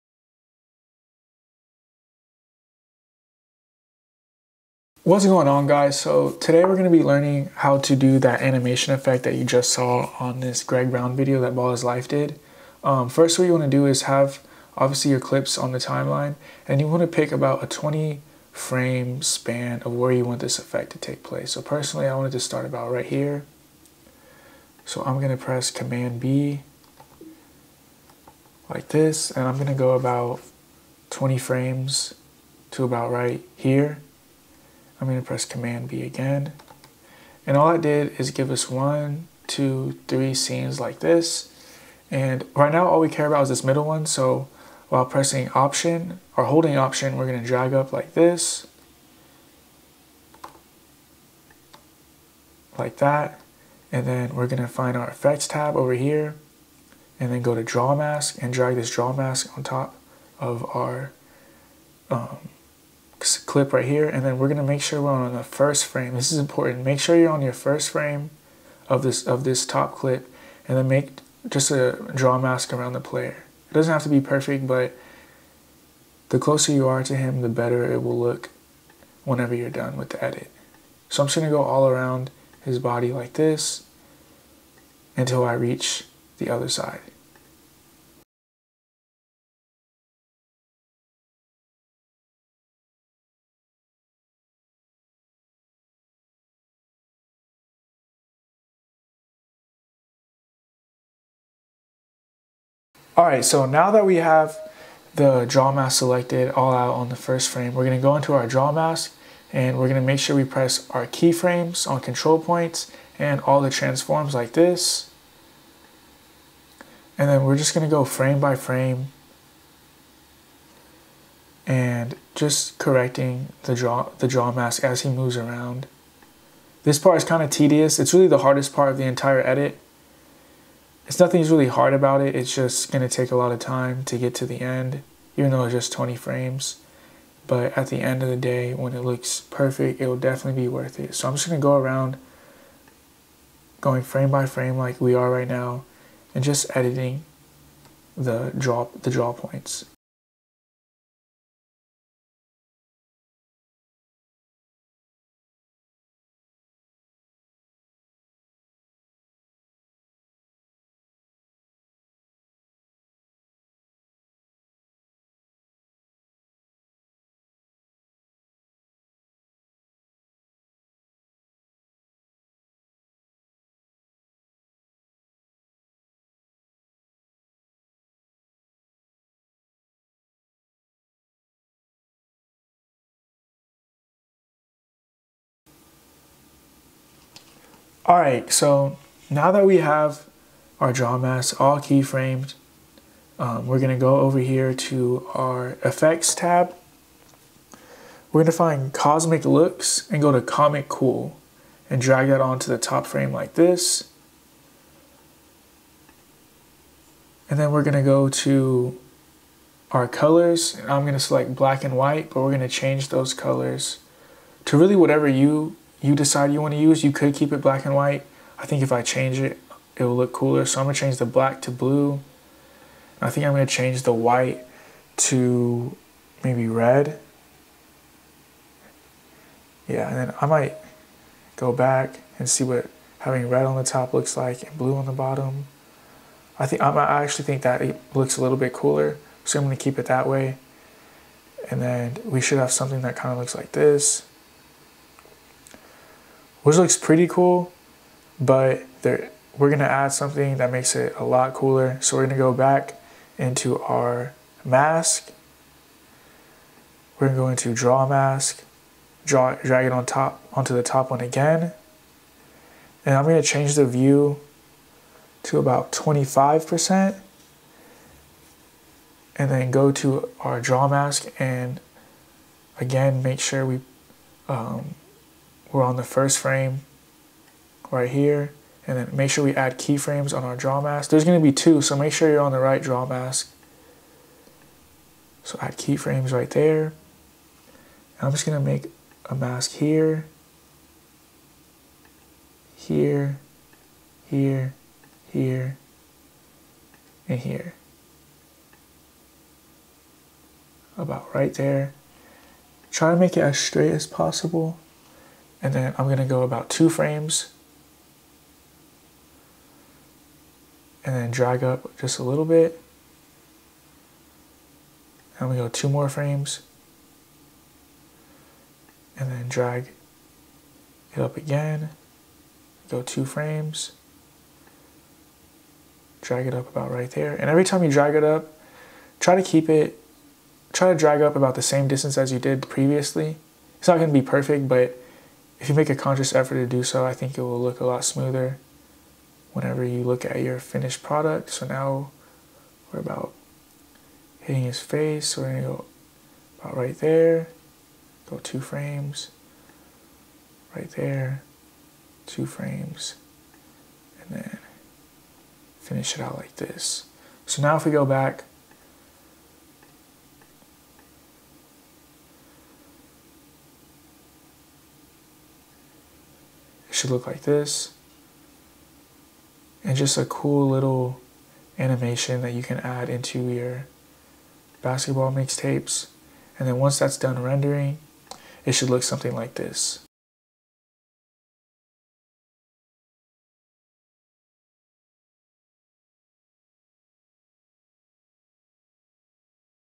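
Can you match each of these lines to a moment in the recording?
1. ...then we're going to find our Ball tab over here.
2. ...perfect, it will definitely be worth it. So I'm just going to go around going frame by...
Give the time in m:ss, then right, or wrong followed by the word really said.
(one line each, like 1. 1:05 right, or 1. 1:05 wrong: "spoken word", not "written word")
1. 0:54 wrong: "Effects", not "Ball"
2. 2:19 right.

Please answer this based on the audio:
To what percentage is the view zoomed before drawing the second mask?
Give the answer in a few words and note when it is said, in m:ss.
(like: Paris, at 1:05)
25%, at 4:25.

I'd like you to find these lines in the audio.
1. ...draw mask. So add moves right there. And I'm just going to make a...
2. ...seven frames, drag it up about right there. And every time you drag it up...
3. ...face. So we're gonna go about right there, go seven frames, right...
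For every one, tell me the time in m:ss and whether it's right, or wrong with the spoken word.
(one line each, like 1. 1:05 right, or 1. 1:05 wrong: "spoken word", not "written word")
1. 4:42 wrong: "keyframes", not "moves"
2. 5:23 wrong: "two", not "seven"
3. 5:44 wrong: "two", not "seven".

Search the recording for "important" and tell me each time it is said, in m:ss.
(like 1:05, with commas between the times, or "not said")
1:06.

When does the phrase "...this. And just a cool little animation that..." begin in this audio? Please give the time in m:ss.
6:07.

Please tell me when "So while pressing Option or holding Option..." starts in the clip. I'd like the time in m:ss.
0:44.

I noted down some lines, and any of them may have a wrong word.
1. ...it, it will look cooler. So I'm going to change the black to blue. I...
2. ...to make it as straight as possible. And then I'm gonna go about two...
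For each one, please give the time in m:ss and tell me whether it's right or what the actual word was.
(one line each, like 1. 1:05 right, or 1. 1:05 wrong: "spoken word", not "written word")
1. 3:39 right
2. 5:03 right.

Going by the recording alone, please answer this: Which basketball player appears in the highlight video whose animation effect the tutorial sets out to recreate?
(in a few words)
Greg Brown.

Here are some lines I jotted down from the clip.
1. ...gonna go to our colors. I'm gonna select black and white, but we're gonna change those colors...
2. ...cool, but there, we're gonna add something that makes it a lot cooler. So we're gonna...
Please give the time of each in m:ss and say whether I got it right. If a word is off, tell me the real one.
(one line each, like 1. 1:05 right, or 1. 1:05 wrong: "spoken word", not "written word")
1. 3:27 right
2. 4:07 right.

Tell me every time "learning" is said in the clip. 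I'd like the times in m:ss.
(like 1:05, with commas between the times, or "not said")
0:07.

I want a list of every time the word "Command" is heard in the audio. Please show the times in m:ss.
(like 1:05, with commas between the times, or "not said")
0:25, 0:35.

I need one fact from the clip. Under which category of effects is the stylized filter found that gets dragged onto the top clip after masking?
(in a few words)
Comic looks.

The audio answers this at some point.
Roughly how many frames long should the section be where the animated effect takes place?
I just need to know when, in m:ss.
0:17.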